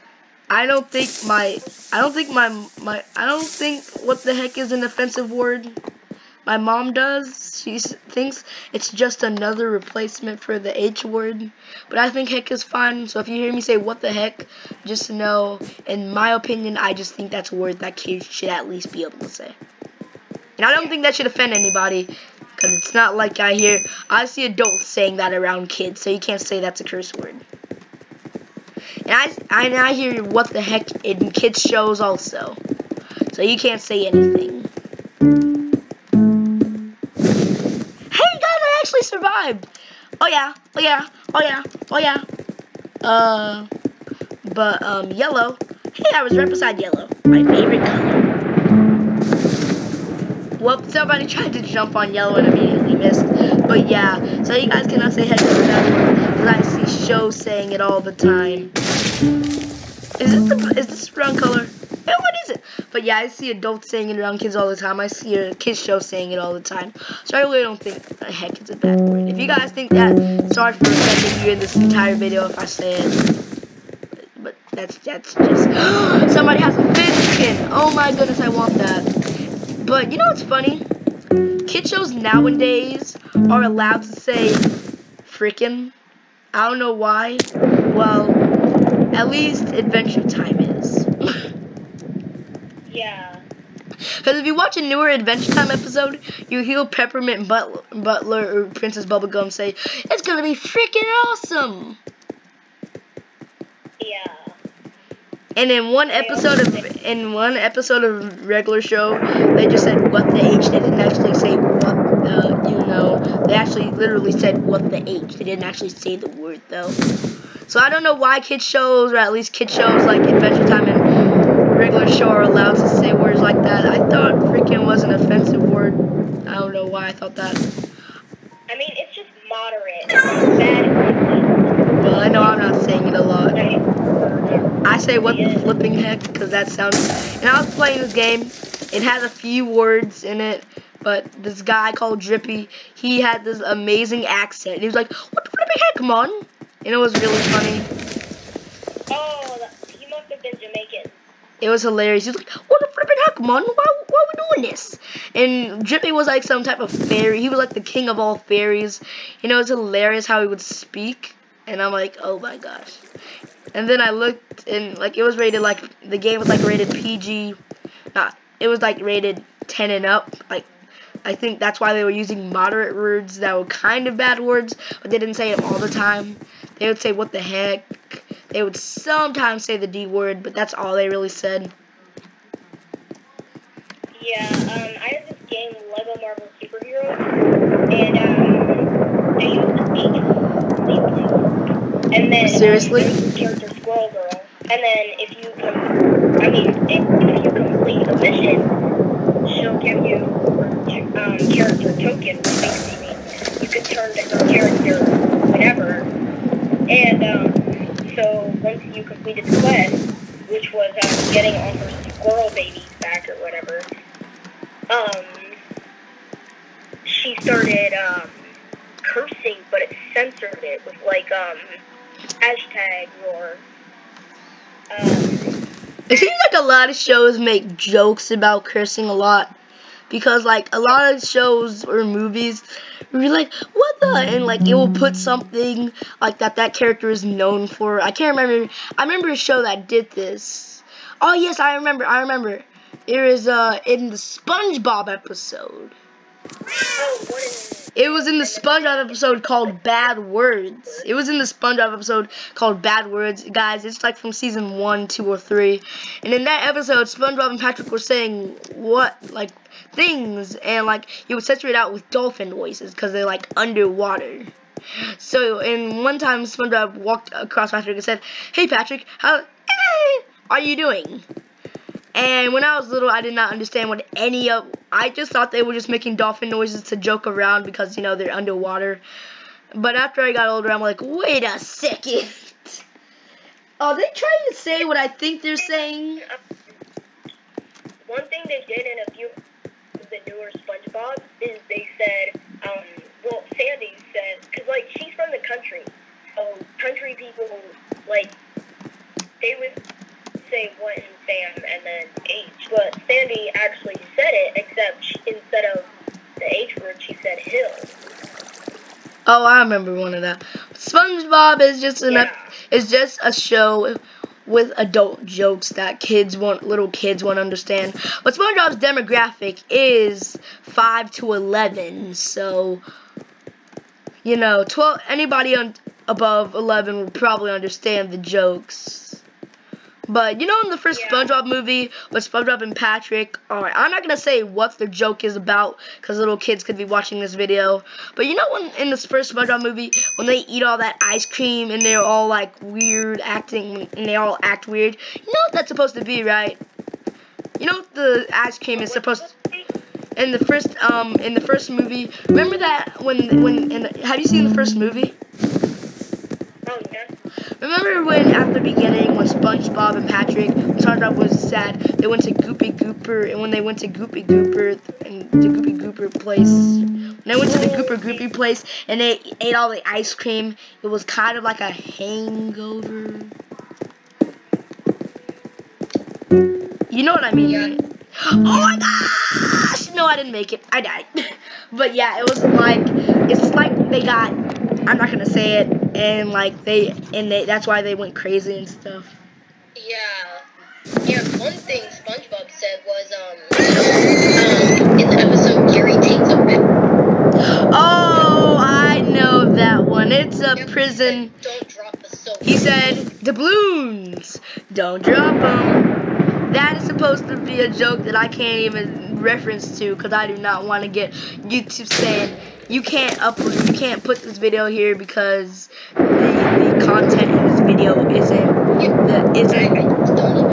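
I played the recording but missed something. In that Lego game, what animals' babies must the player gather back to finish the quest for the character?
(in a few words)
squirrel.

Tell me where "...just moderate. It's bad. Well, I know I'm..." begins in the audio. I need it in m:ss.
2:09.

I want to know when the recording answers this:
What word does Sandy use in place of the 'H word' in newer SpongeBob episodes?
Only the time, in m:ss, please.
5:07.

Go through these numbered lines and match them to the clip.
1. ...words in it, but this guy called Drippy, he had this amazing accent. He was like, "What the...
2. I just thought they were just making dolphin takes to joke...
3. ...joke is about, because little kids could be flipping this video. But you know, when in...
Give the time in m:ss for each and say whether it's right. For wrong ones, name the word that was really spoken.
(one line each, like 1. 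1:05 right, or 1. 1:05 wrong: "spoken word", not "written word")
1. 2:19 right
2. 4:34 wrong: "noises", not "takes"
3. 5:34 wrong: "watching", not "flipping".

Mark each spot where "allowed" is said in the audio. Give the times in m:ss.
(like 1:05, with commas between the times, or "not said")
1:23, 2:02.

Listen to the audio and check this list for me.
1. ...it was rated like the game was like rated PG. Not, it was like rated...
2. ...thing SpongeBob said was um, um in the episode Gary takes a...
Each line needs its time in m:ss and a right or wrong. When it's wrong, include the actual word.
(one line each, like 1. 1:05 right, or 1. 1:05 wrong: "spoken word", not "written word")
1. 2:45 right
2. 6:31 right.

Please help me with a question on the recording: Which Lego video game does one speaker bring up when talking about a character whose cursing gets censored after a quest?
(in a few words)
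Lego Marvel Superheroes.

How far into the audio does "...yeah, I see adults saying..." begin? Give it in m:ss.
1:03.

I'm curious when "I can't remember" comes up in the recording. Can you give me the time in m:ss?
3:58.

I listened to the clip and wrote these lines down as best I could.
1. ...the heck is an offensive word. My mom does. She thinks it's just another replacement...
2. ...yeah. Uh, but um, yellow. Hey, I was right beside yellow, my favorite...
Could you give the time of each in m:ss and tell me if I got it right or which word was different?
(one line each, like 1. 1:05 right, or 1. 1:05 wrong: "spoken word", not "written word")
1. 0:04 right
2. 0:41 right.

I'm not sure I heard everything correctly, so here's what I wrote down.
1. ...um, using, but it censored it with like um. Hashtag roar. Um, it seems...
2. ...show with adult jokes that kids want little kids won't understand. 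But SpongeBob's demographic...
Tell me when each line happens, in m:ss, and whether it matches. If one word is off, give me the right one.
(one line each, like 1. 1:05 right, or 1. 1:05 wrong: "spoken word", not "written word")
1. 3:37 wrong: "cursing", not "using"
2. 5:13 right.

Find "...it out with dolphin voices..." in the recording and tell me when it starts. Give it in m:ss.
4:21.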